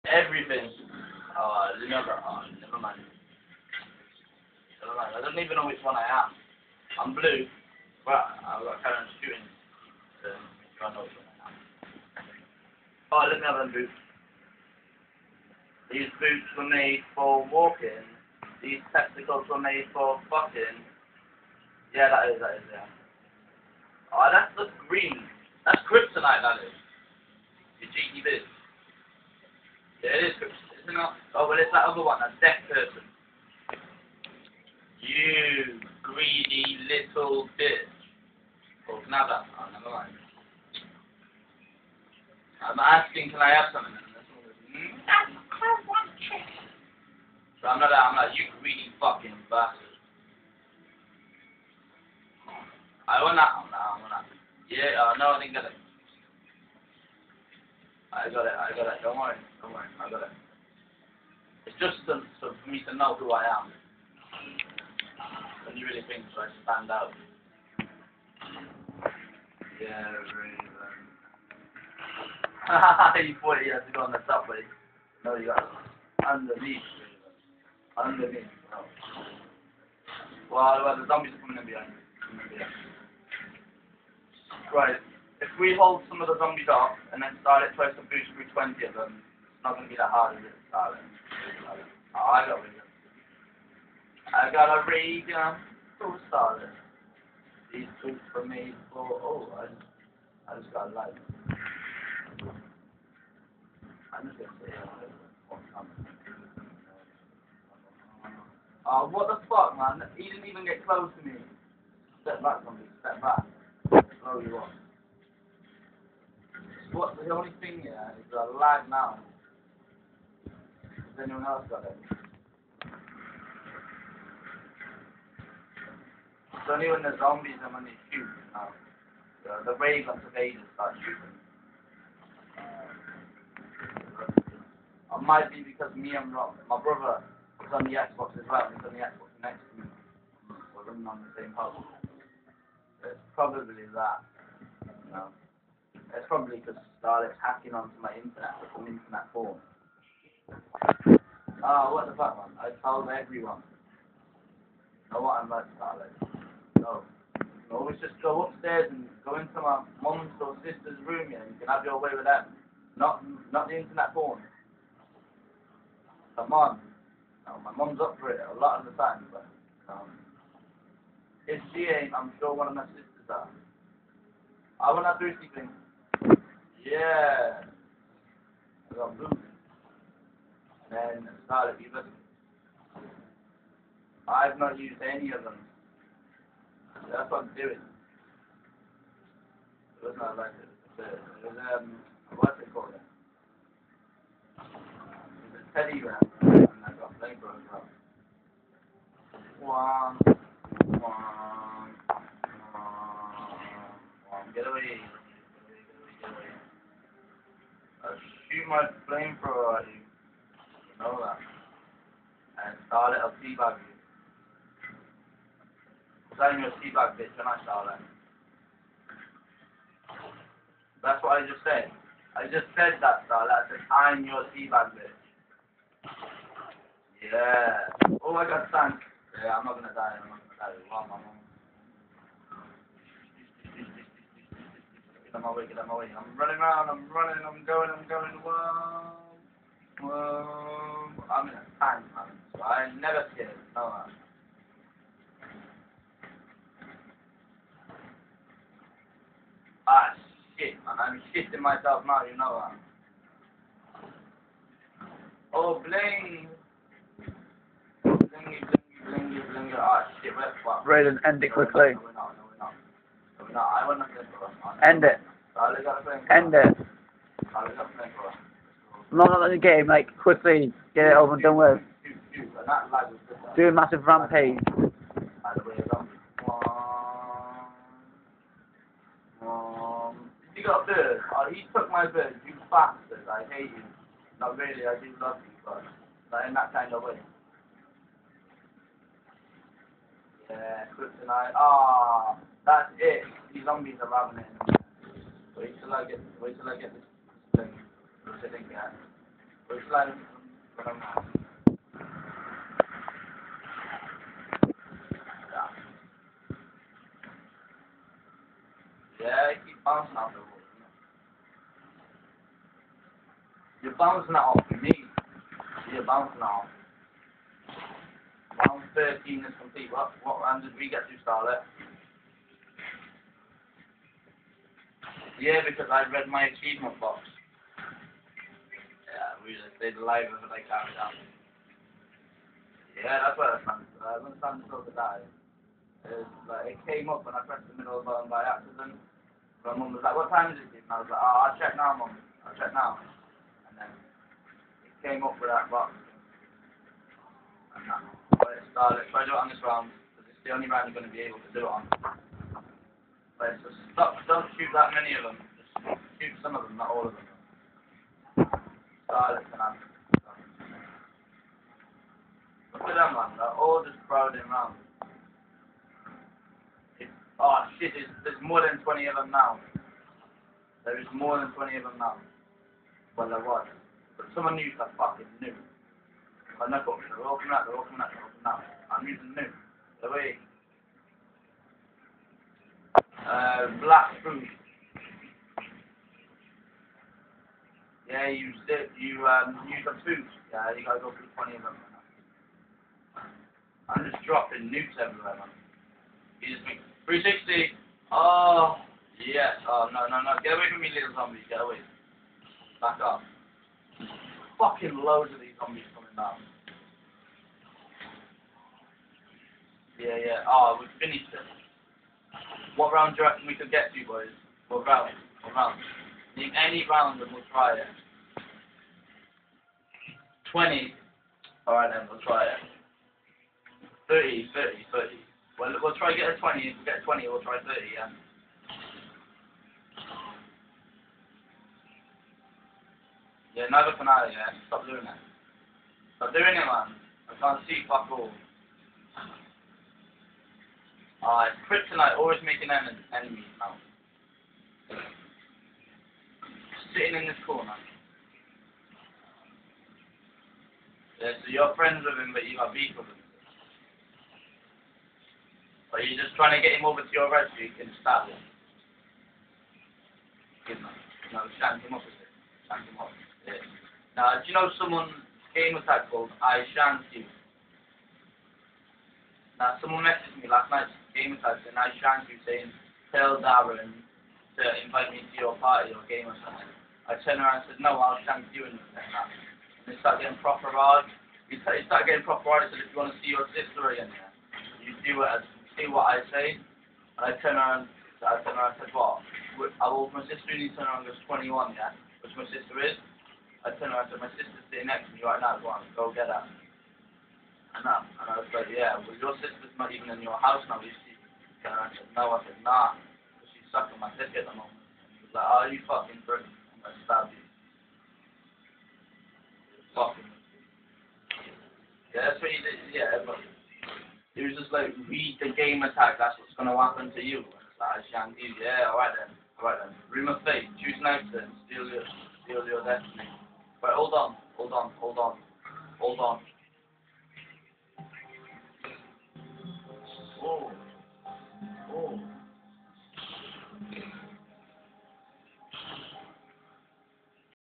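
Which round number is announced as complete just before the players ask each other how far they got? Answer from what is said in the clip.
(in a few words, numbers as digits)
13.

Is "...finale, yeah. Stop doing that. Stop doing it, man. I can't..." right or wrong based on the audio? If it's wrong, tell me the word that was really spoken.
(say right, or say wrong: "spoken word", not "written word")
right.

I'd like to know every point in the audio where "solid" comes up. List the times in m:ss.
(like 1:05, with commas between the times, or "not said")
1:36.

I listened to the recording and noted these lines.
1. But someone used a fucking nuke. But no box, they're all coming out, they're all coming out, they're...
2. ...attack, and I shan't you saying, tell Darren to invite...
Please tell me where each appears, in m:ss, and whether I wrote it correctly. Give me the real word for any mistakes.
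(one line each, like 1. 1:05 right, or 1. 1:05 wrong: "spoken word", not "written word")
1. 6:14 right
2. 7:51 right.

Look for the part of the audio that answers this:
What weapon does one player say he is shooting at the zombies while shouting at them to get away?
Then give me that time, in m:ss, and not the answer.
3:29.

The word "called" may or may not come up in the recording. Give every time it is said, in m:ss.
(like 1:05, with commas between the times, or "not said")
3:12, 7:46.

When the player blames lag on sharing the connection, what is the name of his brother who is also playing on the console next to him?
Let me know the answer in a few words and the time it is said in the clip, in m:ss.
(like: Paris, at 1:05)
Rob, at 2:16.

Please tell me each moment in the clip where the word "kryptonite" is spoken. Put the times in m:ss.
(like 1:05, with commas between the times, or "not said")
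0:25, 4:50, 7:21.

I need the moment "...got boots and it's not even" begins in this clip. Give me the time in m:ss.
2:58.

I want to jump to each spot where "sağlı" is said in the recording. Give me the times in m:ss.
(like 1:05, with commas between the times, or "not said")
3:33, 3:37.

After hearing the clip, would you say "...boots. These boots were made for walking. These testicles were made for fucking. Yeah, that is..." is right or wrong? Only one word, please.
right.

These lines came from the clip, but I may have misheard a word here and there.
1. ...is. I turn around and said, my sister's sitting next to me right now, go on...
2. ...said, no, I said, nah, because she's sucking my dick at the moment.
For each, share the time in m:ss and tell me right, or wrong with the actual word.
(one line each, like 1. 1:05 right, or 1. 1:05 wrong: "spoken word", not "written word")
1. 8:12 right
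2. 8:21 right.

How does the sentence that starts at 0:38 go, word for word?
I I'm asking, can I have something?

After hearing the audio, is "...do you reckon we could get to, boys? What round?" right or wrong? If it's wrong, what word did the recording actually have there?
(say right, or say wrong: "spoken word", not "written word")
right.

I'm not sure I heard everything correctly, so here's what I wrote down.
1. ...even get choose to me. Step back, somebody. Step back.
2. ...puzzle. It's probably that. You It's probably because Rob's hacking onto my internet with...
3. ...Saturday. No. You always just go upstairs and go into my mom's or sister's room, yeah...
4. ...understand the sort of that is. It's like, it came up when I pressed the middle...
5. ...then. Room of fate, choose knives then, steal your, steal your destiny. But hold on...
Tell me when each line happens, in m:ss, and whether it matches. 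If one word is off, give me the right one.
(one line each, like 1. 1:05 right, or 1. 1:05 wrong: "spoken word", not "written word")
1. 1:50 wrong: "close", not "choose"
2. 2:21 wrong: "Starlet", not "Rob"
3. 2:35 right
4. 5:34 right
5. 8:39 right.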